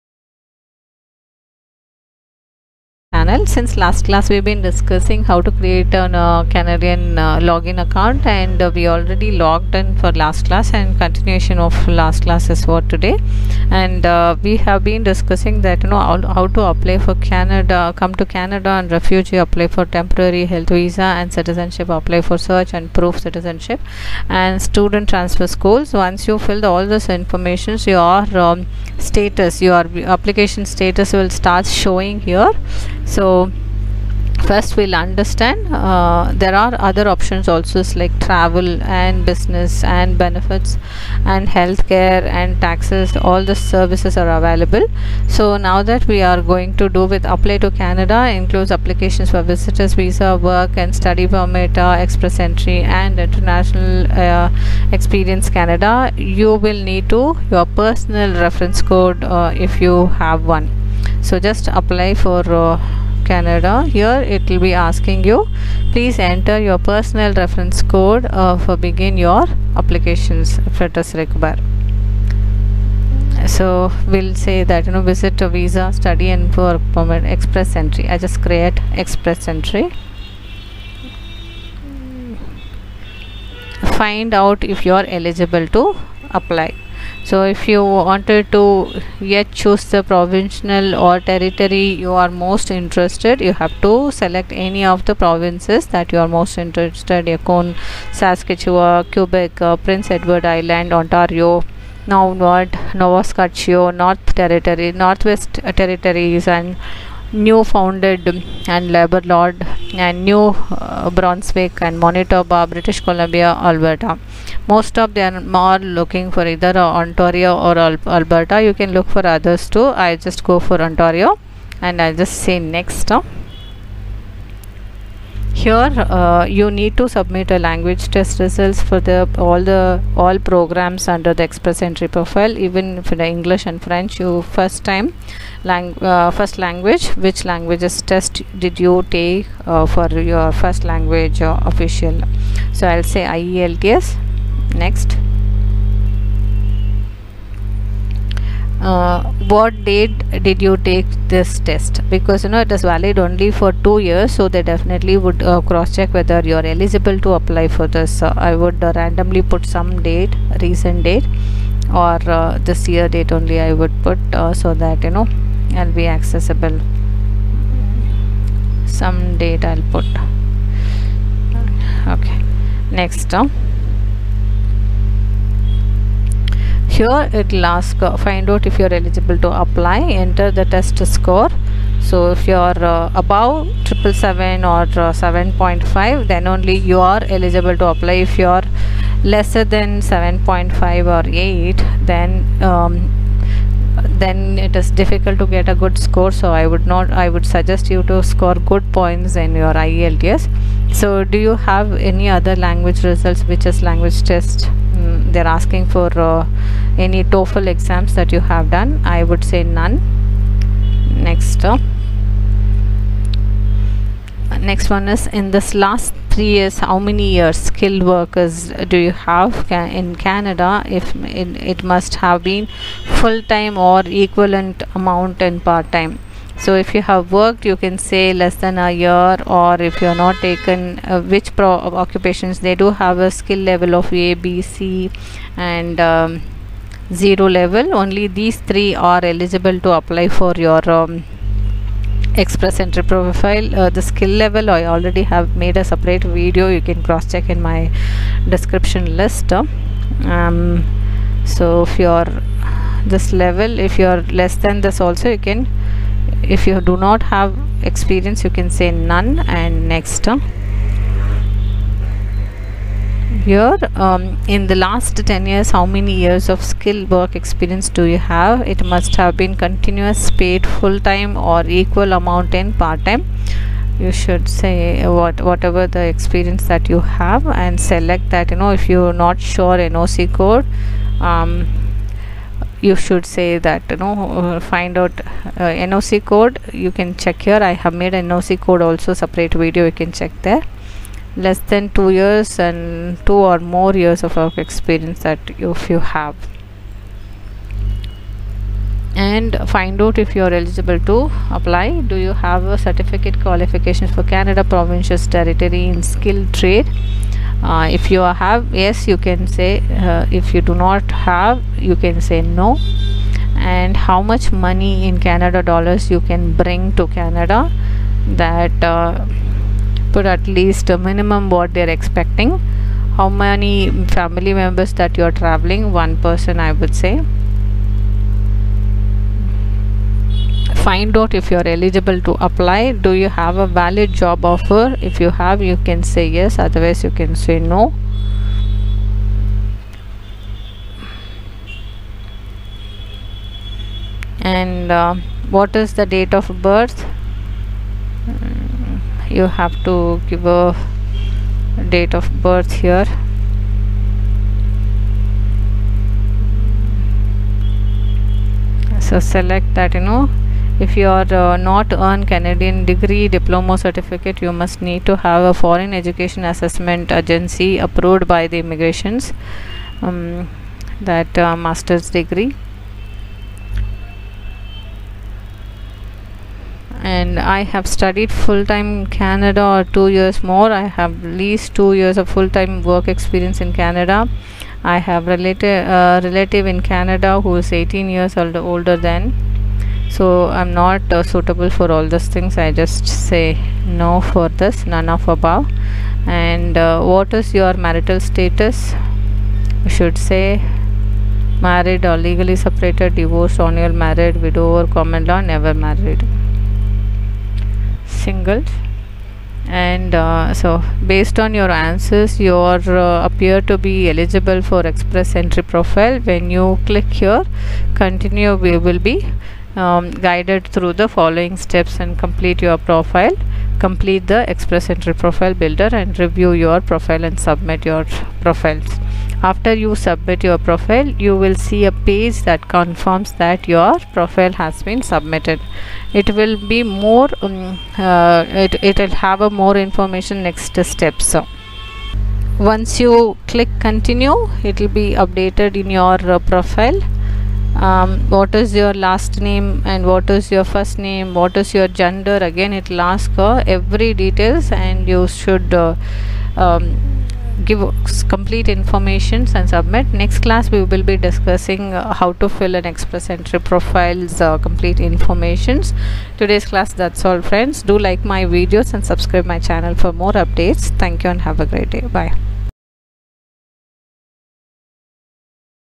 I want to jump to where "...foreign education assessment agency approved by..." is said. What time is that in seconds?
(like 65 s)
365 s.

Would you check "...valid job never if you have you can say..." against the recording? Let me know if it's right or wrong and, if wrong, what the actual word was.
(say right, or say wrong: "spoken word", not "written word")
wrong: "offer", not "never".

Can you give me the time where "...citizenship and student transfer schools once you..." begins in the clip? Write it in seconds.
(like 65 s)
23 s.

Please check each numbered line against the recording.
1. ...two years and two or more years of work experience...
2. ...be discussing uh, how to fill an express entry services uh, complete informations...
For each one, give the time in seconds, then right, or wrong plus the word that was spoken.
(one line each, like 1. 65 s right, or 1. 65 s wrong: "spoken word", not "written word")
1. 291 s right
2. 461 s wrong: "profiles", not "services".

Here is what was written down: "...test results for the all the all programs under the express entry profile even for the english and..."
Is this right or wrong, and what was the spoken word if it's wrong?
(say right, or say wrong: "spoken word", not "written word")
right.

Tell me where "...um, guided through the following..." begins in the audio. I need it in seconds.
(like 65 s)
419 s.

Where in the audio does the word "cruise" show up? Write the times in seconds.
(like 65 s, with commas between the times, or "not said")
not said.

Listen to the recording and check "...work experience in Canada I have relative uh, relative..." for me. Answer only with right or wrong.
right.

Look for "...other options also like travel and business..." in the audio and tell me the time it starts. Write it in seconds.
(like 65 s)
36 s.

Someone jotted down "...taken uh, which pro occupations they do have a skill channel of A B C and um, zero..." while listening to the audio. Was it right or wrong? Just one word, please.
wrong.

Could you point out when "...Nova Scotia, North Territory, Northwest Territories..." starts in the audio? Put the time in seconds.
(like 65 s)
102 s.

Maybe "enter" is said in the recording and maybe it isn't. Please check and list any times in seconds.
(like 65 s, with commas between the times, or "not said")
66 s, 180 s.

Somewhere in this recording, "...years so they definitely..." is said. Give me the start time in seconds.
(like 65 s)
153 s.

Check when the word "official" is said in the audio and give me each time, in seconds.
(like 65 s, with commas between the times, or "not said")
141 s.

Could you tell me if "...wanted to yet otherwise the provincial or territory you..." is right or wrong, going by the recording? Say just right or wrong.
wrong.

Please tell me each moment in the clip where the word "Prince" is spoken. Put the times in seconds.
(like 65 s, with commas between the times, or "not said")
99 s.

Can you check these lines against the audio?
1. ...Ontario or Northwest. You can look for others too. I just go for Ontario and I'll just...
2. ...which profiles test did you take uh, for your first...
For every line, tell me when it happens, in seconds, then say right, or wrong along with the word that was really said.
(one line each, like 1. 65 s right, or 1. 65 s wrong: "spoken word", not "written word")
1. 116 s wrong: "Alberta", not "Northwest"
2. 137 s wrong: "languages", not "profiles".